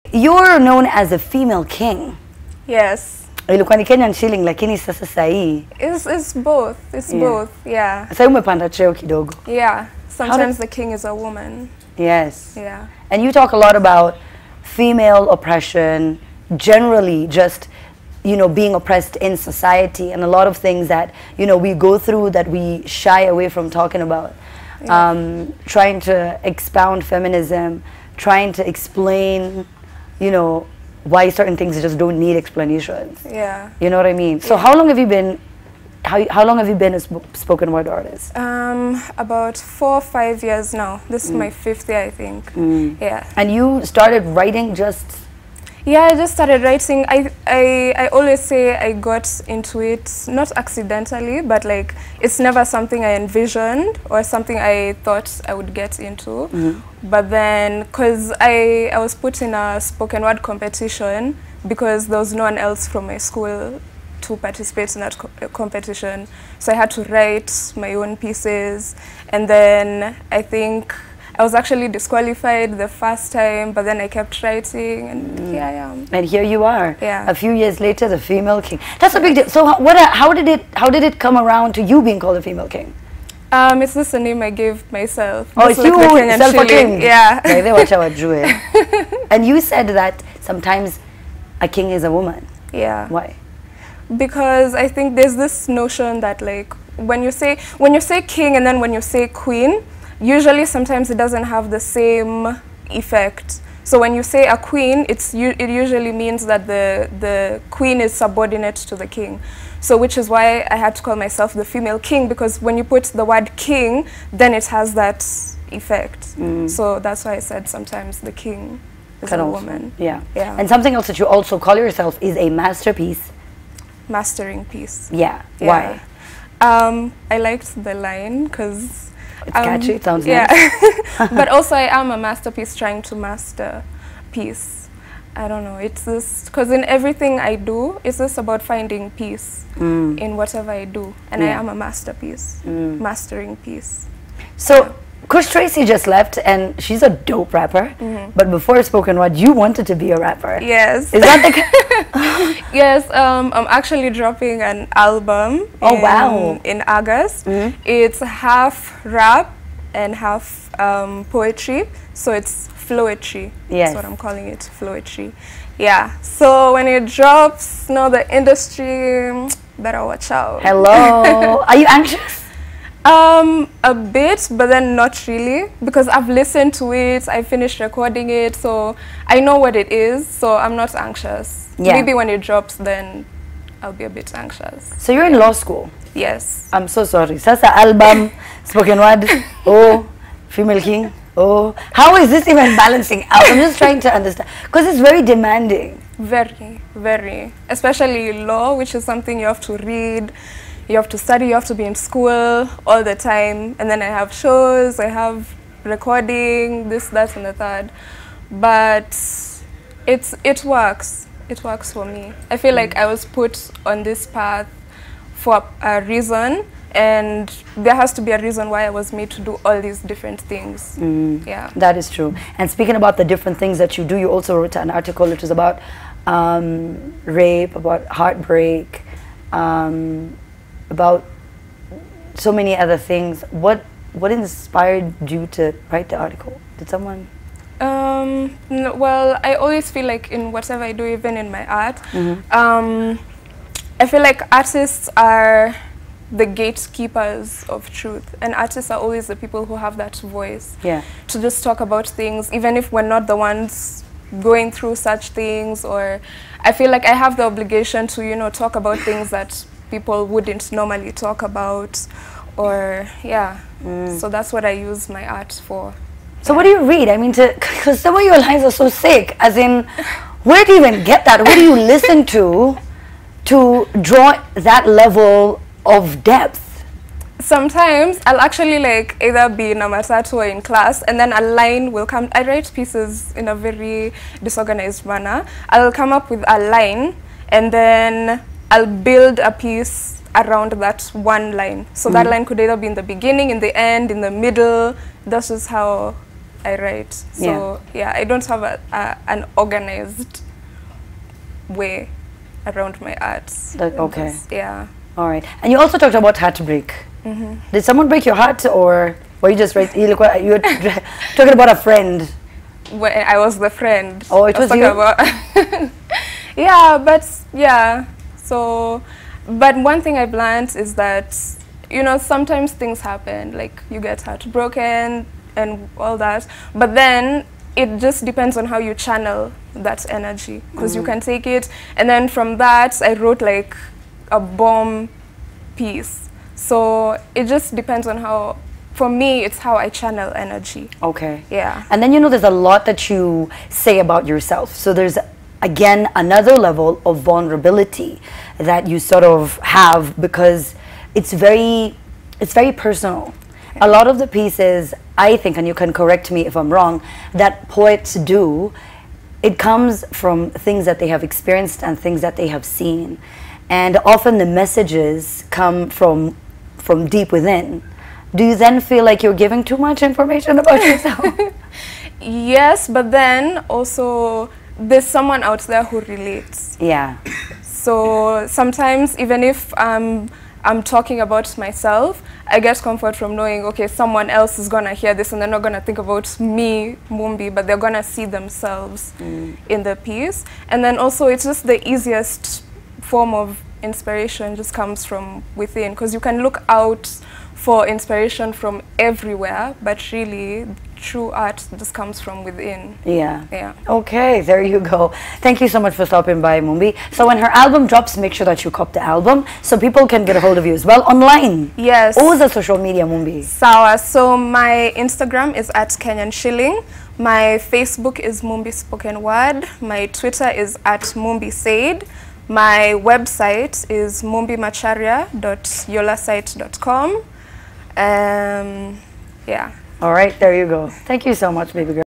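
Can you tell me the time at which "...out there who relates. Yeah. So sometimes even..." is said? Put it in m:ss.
6:15.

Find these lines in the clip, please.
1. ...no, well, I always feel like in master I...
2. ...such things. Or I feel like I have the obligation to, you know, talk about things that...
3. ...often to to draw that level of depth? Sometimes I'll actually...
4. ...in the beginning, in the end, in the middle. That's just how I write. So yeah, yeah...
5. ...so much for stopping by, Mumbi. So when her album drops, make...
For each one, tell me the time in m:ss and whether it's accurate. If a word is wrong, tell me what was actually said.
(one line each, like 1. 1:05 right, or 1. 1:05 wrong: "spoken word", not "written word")
1. 3:58 wrong: "whatever", not "master"
2. 4:14 right
3. 4:31 wrong: "listen", not "often"
4. 4:52 right
5. 6:45 right.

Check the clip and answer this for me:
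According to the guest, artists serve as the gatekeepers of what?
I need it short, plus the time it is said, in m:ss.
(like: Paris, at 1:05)
Truth, at 4:06.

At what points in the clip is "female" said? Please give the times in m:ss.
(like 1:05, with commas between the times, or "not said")
0:01, 0:14, 1:18, 1:22, 1:51, 3:10.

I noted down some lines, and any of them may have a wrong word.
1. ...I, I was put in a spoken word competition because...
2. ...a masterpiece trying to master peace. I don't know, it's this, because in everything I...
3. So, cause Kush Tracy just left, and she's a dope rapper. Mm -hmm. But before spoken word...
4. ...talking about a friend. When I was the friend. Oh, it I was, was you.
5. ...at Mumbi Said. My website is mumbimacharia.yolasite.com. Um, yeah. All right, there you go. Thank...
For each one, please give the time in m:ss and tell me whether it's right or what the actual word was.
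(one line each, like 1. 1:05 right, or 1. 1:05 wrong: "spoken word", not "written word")
1. 0:58 right
2. 2:12 right
3. 2:24 right
4. 5:11 right
5. 7:00 right.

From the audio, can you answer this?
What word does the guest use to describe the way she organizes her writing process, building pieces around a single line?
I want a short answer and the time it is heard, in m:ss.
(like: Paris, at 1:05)
Disorganized, at 4:44.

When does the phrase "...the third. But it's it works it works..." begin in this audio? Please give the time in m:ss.
3:27.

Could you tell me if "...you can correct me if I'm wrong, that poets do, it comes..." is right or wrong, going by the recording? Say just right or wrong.
right.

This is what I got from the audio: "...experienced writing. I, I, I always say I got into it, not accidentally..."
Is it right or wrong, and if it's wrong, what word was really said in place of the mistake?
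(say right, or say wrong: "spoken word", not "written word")
wrong: "started", not "experienced".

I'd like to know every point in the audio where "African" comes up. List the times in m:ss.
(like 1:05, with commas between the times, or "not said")
not said.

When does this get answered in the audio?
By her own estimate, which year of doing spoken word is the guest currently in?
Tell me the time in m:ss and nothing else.
0:41.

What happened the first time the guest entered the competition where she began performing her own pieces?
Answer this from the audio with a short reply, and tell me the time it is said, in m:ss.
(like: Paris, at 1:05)
Disqualified, at 1:11.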